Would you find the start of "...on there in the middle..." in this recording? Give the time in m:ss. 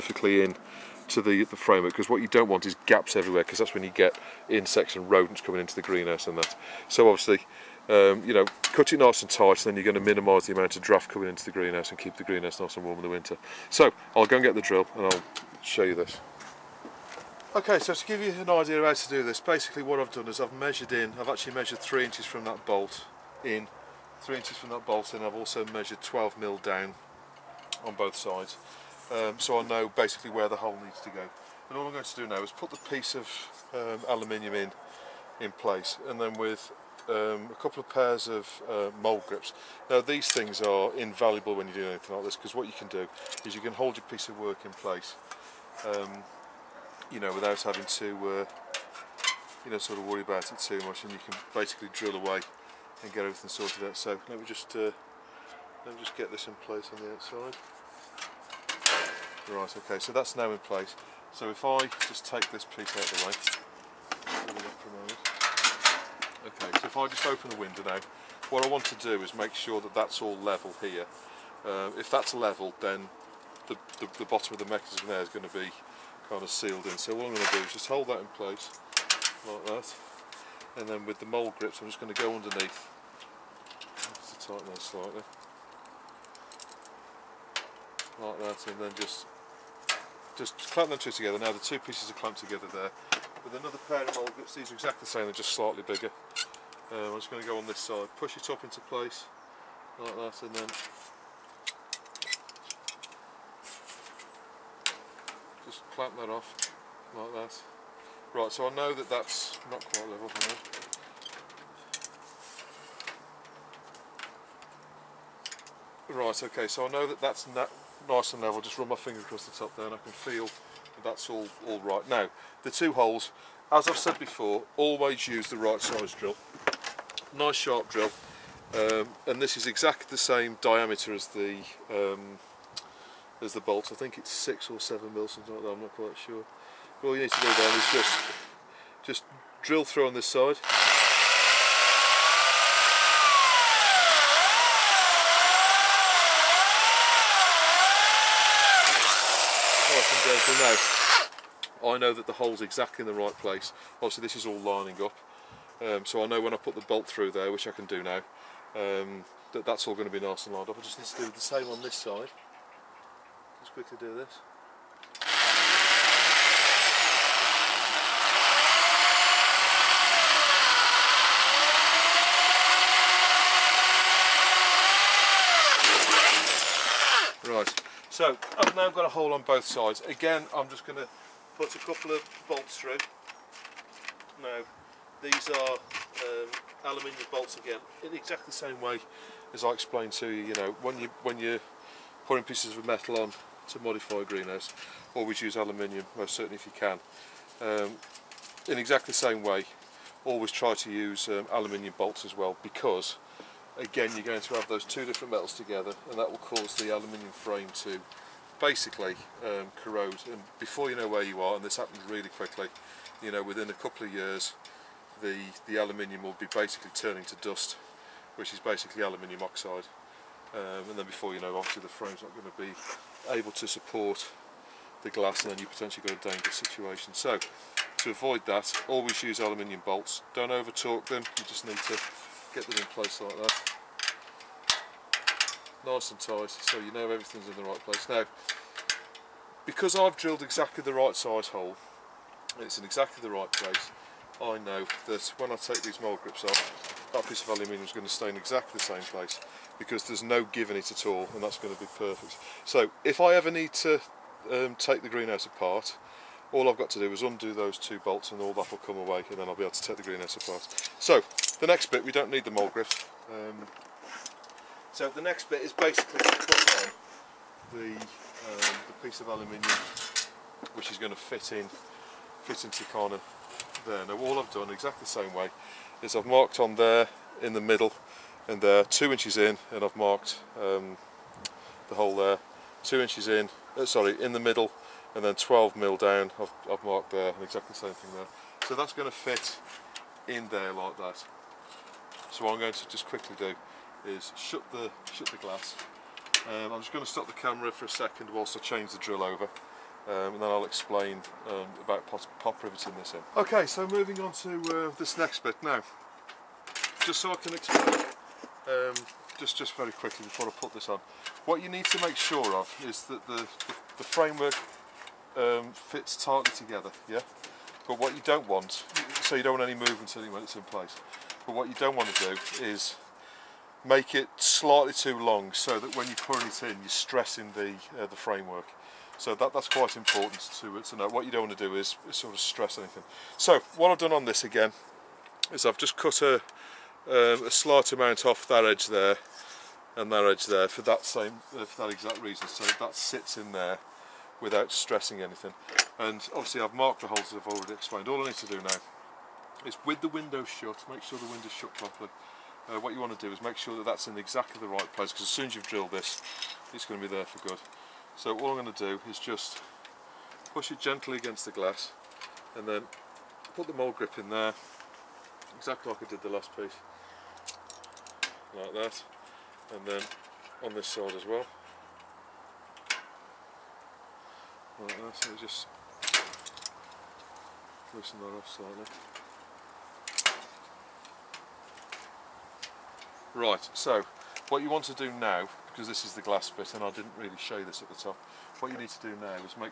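4:36.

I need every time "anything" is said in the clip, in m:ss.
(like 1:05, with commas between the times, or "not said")
0:41, 5:32, 5:45.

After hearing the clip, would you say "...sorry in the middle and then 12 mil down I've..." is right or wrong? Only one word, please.
right.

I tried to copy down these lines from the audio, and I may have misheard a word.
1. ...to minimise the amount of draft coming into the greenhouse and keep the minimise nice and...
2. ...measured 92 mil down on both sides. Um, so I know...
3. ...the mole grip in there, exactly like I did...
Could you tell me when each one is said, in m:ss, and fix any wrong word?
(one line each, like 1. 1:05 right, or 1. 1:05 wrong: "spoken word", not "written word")
1. 0:10 wrong: "greenhouse", not "minimise"
2. 0:25 wrong: "12", not "92"
3. 6:03 right.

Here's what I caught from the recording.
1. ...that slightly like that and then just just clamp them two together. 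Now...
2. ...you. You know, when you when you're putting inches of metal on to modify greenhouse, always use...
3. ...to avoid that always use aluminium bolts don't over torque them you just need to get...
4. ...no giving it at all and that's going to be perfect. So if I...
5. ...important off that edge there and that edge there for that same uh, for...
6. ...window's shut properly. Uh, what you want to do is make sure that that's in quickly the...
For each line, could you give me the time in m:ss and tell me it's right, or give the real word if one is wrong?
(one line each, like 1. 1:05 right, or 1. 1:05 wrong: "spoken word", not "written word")
1. 1:24 right
2. 3:10 wrong: "pieces", not "inches"
3. 3:47 right
4. 4:10 right
5. 5:37 wrong: "amount", not "important"
6. 5:51 wrong: "exactly", not "quickly".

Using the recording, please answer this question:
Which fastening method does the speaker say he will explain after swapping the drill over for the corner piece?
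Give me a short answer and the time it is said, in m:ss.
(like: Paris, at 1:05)
pop riveting, at 5:02.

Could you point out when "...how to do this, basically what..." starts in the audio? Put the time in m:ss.
0:18.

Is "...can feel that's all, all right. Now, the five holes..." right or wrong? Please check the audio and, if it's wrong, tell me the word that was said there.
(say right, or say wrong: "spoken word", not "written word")
wrong: "two", not "five".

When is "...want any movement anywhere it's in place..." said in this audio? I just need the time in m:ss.
5:19.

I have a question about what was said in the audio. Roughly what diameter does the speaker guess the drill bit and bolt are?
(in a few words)
6 or 7 mm.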